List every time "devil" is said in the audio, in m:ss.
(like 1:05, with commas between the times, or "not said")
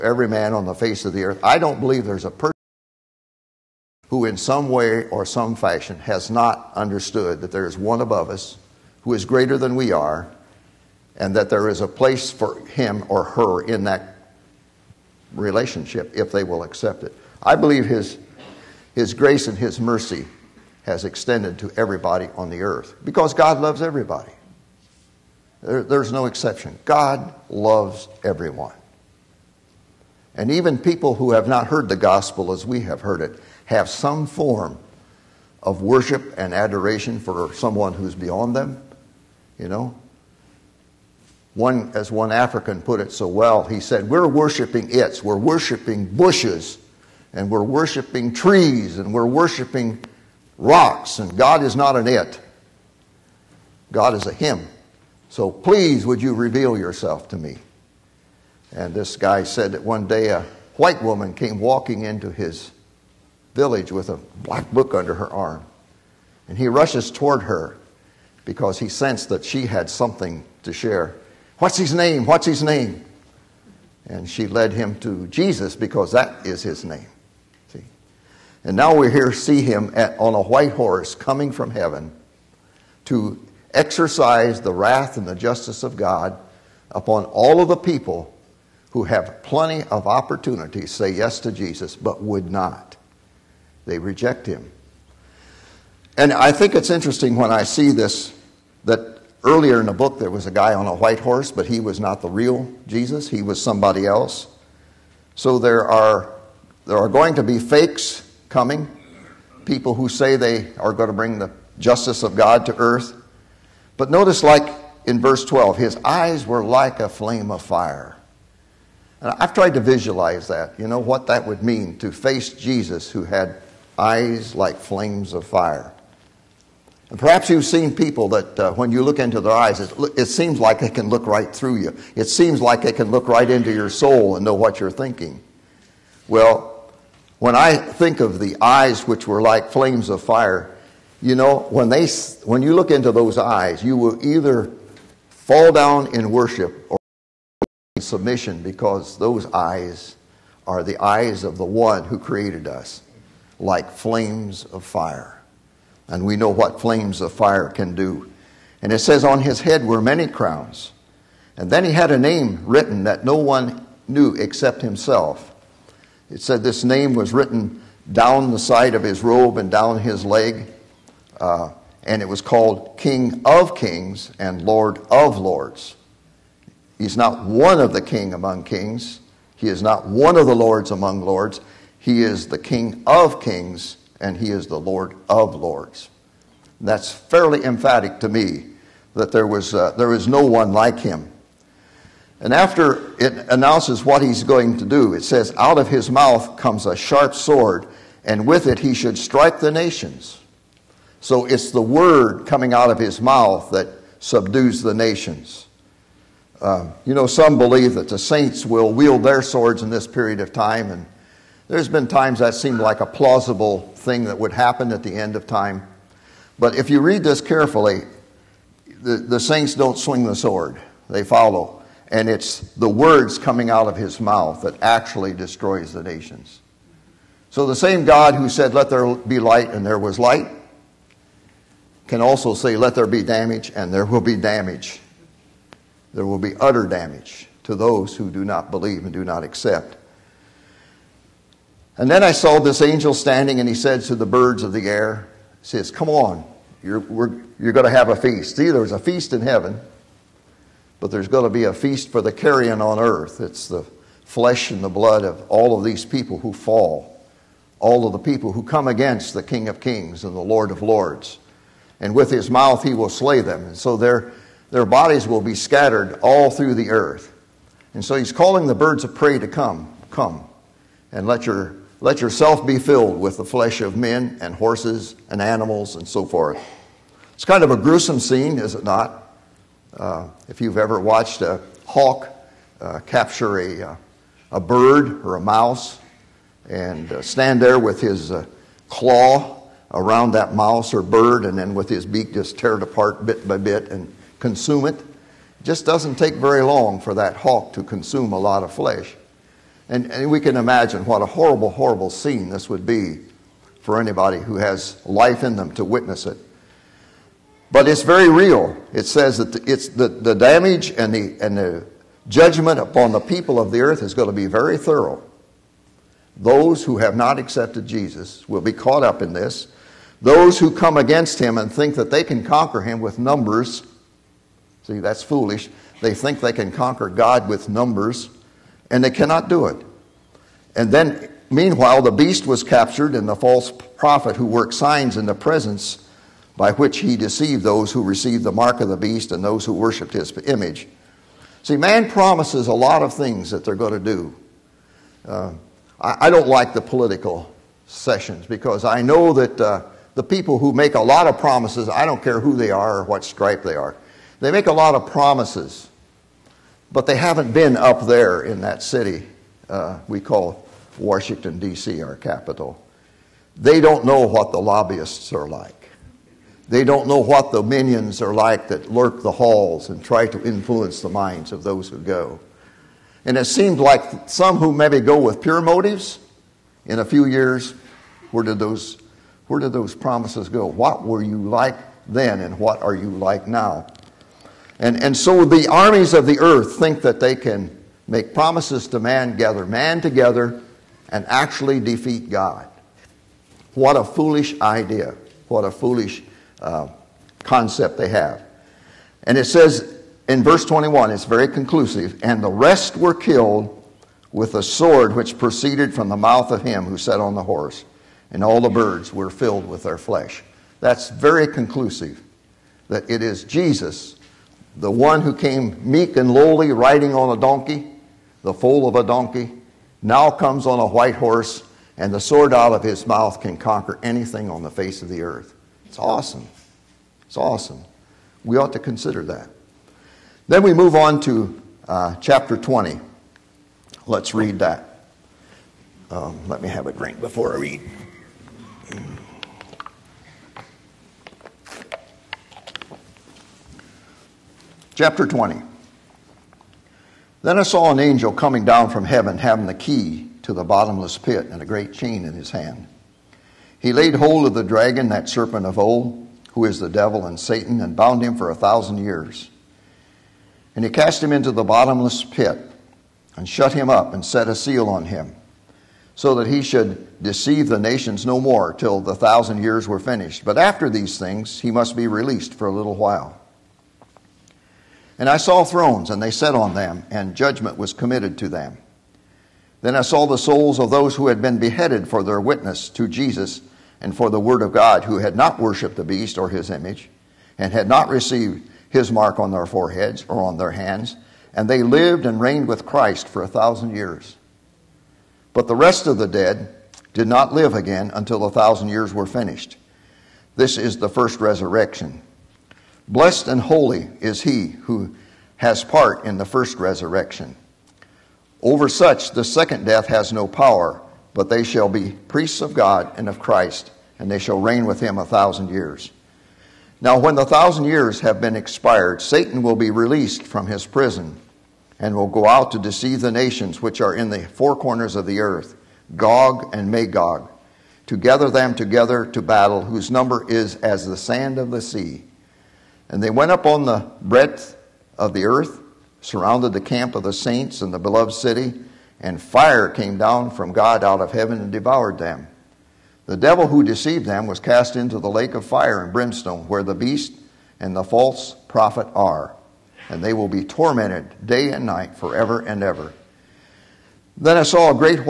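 7:36, 9:03.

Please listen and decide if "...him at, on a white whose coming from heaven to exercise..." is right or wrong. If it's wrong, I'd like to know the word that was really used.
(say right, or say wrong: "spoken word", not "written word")
wrong: "horse", not "whose".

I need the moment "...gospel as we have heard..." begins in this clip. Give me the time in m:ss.
0:31.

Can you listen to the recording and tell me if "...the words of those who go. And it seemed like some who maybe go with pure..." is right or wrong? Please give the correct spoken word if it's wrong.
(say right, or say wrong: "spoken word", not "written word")
wrong: "minds", not "words".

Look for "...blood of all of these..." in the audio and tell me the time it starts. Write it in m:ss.
4:14.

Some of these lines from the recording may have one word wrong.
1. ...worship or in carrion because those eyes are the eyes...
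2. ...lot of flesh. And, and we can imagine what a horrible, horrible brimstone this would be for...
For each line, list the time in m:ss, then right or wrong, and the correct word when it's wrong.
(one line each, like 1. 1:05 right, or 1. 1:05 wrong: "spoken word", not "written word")
1. 2:26 wrong: "submission", not "carrion"
2. 4:58 wrong: "scene", not "brimstone".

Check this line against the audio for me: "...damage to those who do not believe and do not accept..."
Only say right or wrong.
right.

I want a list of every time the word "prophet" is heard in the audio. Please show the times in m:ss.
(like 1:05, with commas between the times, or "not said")
5:33, 9:08.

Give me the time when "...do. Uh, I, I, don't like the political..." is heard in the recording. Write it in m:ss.
5:43.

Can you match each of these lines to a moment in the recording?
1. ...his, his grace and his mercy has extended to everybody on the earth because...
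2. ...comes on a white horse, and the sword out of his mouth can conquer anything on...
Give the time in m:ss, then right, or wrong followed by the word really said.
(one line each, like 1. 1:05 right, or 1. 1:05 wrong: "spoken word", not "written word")
1. 0:17 right
2. 7:00 right.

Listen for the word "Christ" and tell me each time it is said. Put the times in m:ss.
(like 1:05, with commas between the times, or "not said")
8:12, 8:33.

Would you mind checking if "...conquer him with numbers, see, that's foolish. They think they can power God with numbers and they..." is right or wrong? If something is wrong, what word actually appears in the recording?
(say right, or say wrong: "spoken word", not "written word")
wrong: "conquer", not "power".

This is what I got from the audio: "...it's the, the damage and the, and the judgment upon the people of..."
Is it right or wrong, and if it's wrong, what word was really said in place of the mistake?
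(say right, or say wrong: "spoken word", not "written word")
right.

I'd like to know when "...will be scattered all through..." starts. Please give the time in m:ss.
4:25.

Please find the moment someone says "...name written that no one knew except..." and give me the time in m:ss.
2:42.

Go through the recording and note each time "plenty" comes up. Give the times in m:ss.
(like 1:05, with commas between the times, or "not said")
1:29.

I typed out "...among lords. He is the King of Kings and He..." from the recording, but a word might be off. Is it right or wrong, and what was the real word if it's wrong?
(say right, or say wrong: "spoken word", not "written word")
right.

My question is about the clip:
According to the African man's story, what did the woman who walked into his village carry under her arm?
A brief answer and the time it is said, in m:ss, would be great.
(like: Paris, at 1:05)
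A black book, at 1:04.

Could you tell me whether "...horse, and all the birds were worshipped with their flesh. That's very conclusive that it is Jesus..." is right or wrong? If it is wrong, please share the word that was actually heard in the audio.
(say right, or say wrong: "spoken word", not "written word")
wrong: "filled", not "worshipped".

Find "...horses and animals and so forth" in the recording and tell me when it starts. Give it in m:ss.
4:34.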